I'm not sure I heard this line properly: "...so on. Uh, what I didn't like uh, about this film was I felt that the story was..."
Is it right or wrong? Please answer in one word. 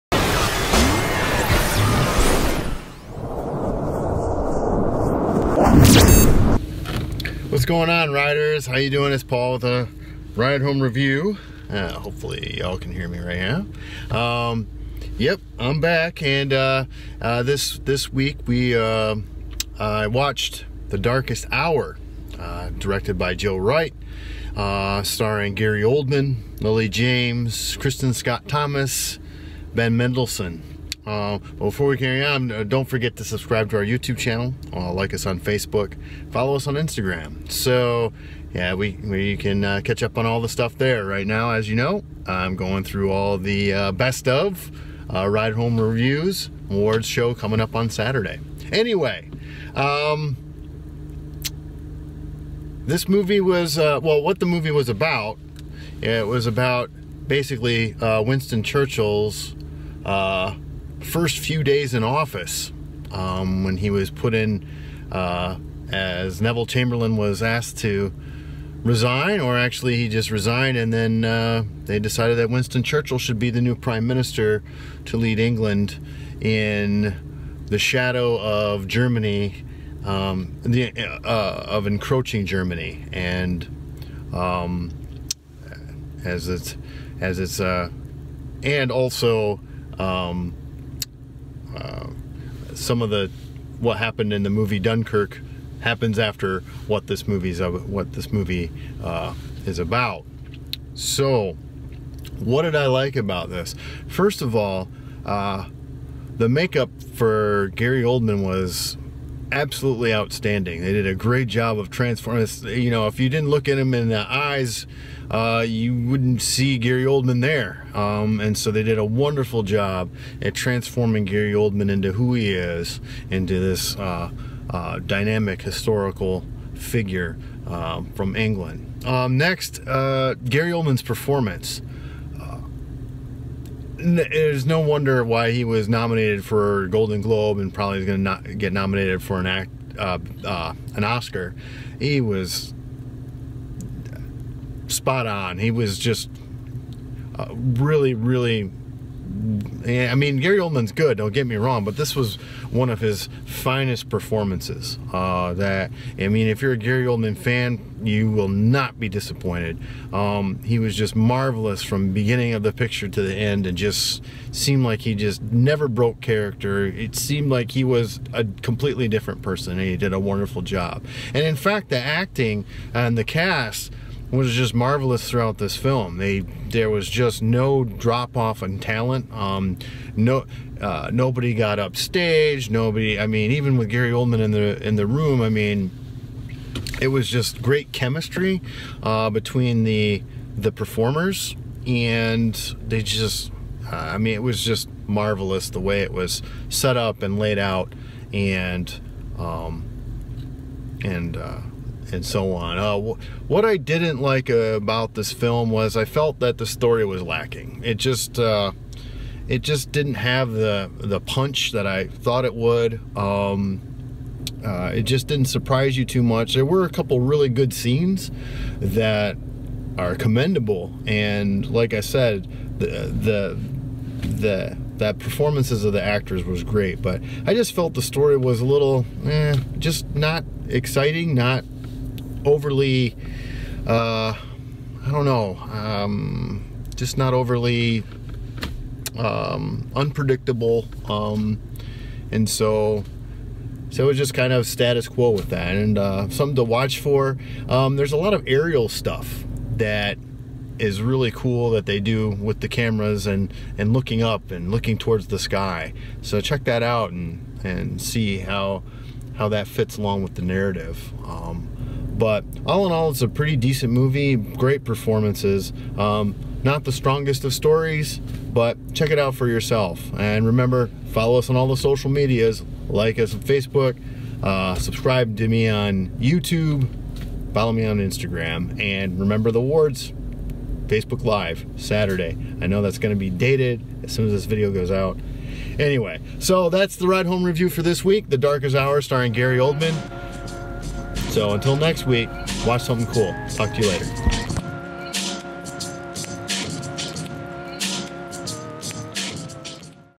right.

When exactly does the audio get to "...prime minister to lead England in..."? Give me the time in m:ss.
1:13.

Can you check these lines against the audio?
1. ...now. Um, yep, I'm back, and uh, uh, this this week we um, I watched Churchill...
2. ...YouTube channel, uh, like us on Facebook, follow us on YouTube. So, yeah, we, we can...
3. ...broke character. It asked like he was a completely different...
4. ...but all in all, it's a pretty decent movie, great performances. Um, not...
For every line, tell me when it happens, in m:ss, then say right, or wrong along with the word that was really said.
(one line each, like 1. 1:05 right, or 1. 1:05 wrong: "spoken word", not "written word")
1. 0:14 wrong: "The", not "Churchill"
2. 0:33 wrong: "Instagram", not "YouTube"
3. 2:45 wrong: "seemed", not "asked"
4. 4:22 right.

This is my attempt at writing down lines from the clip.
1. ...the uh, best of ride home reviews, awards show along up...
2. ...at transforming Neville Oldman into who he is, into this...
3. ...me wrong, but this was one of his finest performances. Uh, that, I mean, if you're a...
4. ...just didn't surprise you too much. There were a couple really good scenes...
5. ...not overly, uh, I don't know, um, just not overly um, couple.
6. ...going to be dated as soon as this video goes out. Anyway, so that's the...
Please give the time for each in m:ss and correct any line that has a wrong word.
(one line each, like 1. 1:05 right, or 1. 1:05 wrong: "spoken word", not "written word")
1. 0:43 wrong: "coming", not "along"
2. 2:00 wrong: "Gary", not "Neville"
3. 2:31 right
4. 3:35 right
5. 3:51 wrong: "unpredictable", not "couple"
6. 4:42 right.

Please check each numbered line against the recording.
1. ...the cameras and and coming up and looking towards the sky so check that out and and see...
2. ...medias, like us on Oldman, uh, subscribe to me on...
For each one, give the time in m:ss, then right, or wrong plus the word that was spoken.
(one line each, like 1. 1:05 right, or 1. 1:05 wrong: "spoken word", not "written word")
1. 4:12 wrong: "looking", not "coming"
2. 4:32 wrong: "Facebook", not "Oldman".